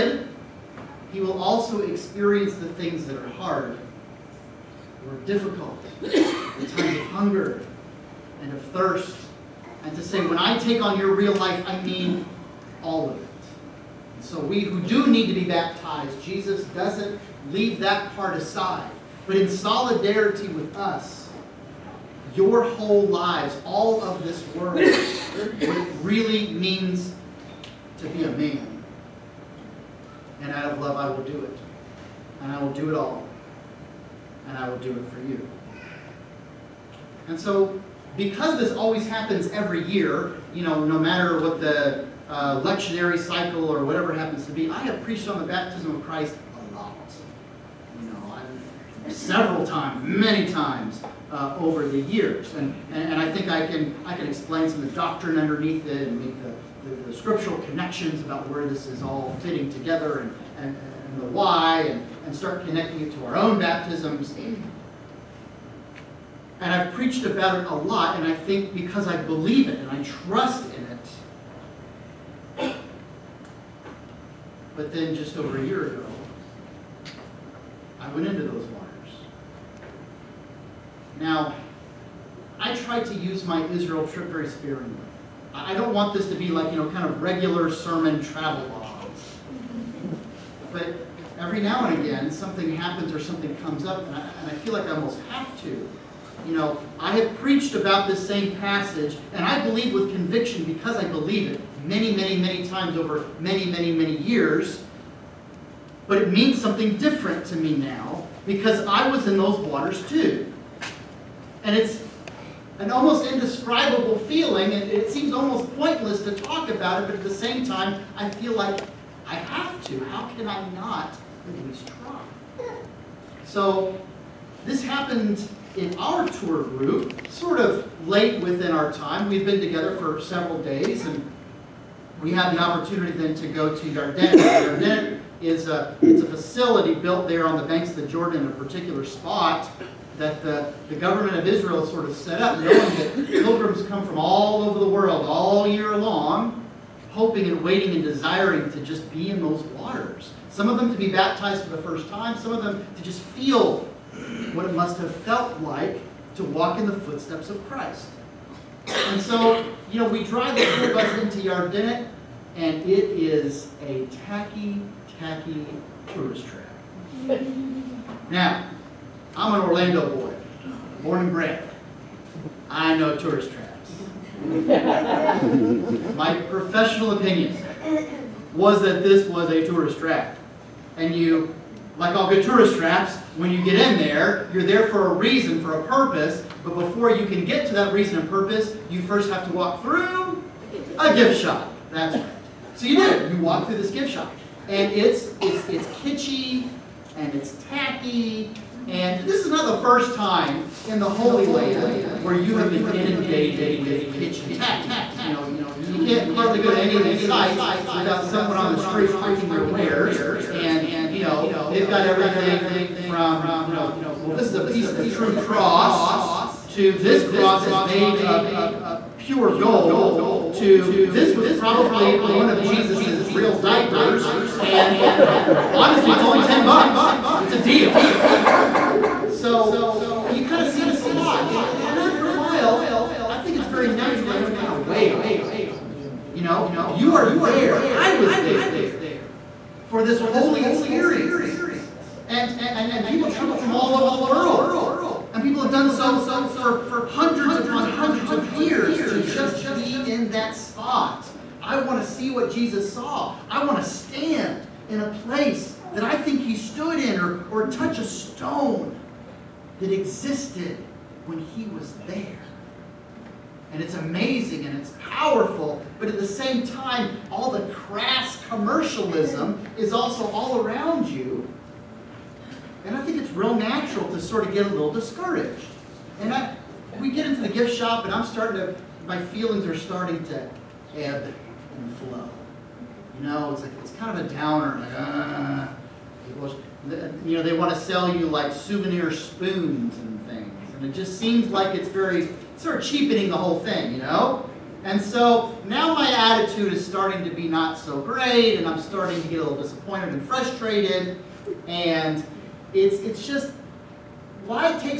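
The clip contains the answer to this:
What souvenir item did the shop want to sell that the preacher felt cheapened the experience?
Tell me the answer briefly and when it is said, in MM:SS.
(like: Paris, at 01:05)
Souvenir spoons, at 04:48.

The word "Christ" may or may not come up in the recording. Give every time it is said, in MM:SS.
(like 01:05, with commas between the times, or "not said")
00:46, 02:37.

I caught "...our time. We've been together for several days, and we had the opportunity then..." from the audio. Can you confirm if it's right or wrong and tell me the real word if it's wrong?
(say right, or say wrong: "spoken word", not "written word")
right.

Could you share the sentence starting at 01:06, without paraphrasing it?
And I've preached about it a lot, and I think because I believe it and I trust in it.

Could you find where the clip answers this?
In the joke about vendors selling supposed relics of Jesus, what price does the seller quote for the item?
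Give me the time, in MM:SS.
03:46.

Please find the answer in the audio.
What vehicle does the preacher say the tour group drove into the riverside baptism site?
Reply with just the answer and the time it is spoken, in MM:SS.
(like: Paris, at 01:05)
School bus, at 02:40.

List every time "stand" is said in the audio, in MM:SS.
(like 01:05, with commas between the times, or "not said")
04:13.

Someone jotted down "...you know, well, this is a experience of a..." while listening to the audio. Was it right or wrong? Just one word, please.
wrong.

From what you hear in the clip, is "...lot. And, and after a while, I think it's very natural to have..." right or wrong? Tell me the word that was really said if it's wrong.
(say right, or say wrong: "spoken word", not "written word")
right.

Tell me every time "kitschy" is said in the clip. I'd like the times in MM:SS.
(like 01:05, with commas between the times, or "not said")
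03:15, 03:24.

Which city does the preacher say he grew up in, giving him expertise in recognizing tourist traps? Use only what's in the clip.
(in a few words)
Orlando.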